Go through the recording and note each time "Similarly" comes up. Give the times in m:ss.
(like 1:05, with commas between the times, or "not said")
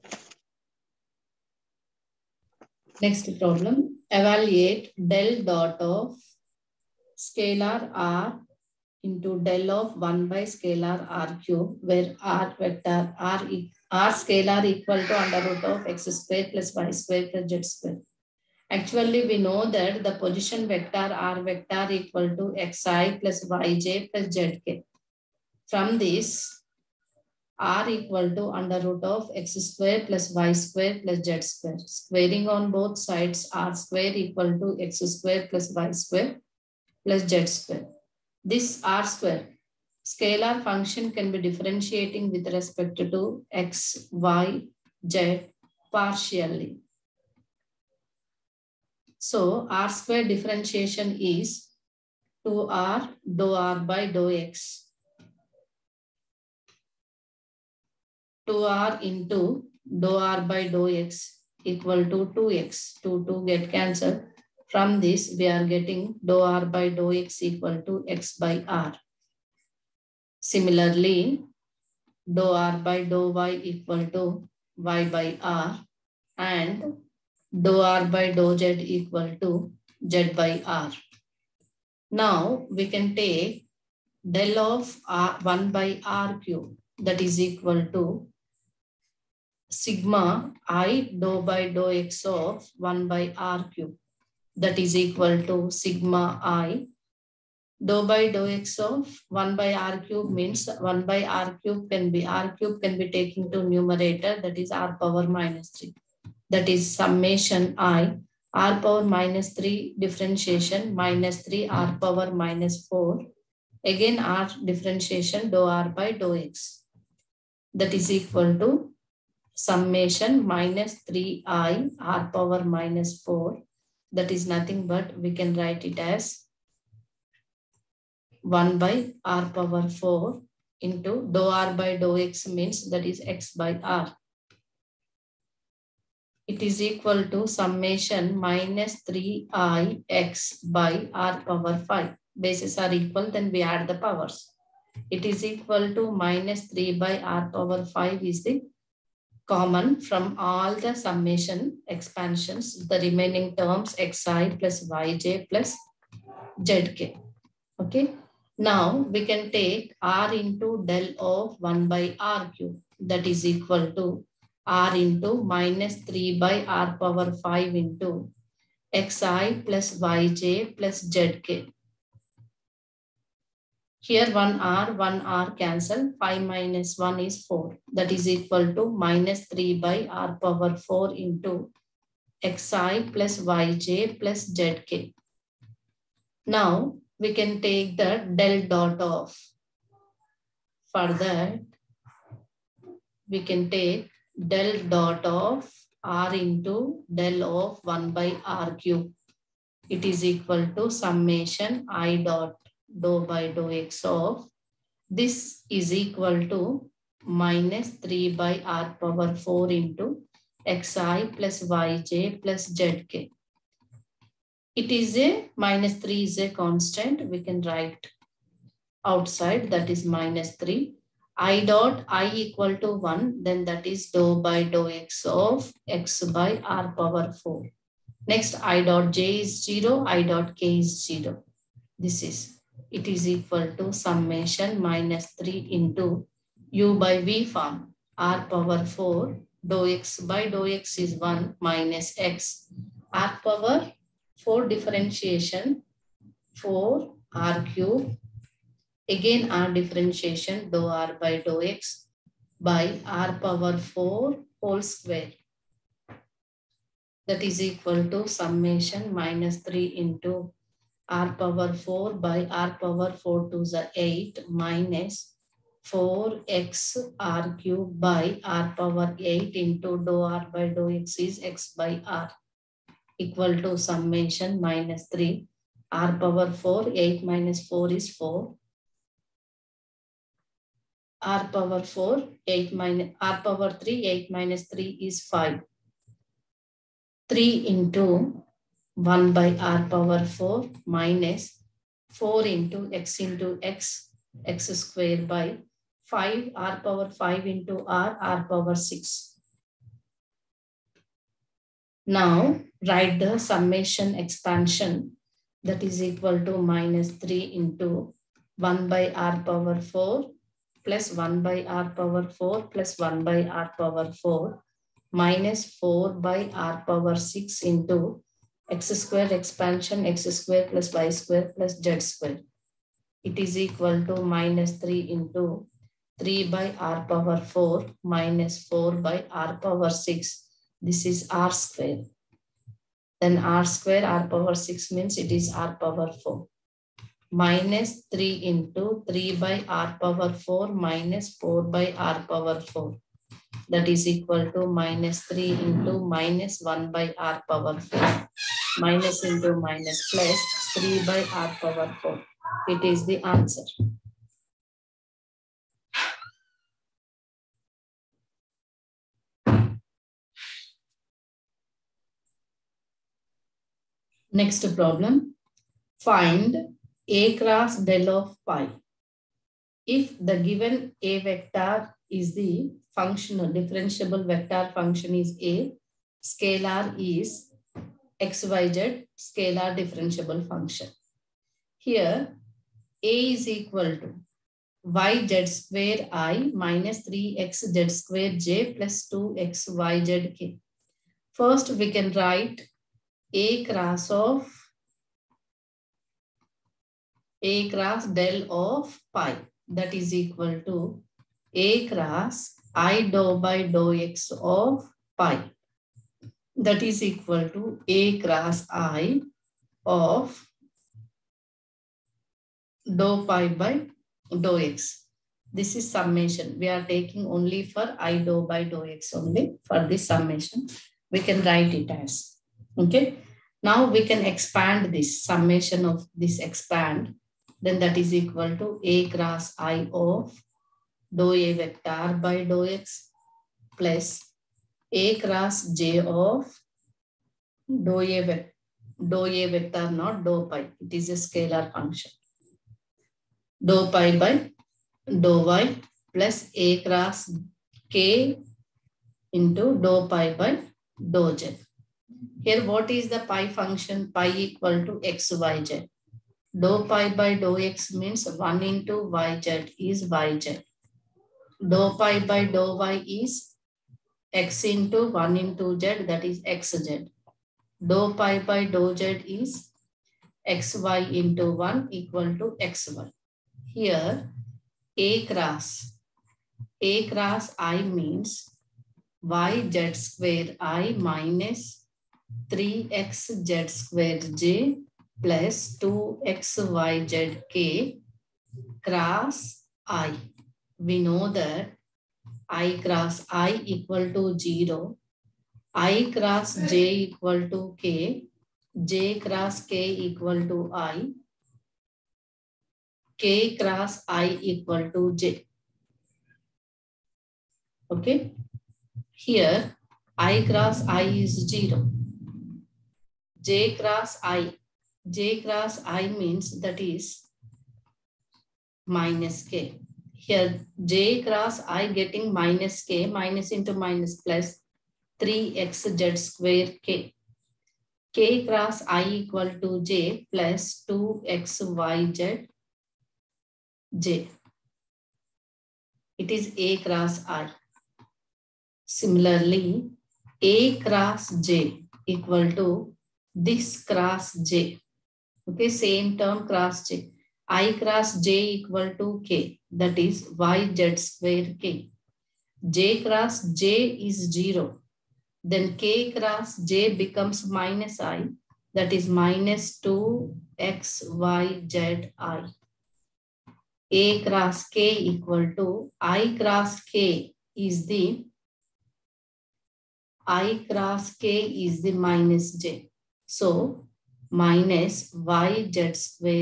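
1:10, 8:58.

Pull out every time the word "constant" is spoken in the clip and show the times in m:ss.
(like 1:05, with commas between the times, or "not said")
3:36.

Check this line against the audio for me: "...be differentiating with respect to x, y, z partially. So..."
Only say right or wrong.
right.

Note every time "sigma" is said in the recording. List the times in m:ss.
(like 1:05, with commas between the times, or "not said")
1:29, 1:35.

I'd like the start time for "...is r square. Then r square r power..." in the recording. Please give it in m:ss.
5:31.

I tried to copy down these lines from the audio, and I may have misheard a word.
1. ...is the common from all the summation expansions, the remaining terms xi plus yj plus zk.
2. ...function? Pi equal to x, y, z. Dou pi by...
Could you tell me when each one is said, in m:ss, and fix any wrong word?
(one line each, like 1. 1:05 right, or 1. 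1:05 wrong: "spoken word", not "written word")
1. 2:28 right
2. 7:33 right.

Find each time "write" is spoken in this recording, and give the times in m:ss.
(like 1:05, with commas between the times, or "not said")
2:05, 3:37, 5:02, 6:32, 7:01.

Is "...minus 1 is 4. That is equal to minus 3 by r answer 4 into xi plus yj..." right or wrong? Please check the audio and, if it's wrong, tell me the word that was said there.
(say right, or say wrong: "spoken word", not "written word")
wrong: "power", not "answer".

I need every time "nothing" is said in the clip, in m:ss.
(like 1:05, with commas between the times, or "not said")
2:04.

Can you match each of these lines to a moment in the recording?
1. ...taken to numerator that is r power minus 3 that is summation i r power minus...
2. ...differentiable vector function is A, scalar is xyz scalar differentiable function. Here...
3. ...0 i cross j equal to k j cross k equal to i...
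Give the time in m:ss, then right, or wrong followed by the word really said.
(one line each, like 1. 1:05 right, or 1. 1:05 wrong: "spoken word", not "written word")
1. 1:43 right
2. 6:13 right
3. 8:14 right.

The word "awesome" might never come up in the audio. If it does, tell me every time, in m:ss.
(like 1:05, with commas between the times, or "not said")
not said.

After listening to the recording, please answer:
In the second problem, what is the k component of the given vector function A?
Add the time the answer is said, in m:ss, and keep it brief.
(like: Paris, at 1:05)
2xyz, at 6:29.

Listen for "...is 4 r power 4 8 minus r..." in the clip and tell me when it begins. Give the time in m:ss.
4:37.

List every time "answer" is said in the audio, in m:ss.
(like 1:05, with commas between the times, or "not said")
5:53.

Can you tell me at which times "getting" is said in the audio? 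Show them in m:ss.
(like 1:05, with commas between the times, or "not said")
1:05, 8:41.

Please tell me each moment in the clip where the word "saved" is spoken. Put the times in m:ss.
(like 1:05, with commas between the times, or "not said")
not said.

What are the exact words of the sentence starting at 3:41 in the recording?
i dot i equal to 1 then that is dou by dou x of x by r power 4.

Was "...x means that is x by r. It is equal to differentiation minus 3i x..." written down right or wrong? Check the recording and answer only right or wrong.
wrong.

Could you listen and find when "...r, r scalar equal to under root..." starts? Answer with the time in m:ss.
0:13.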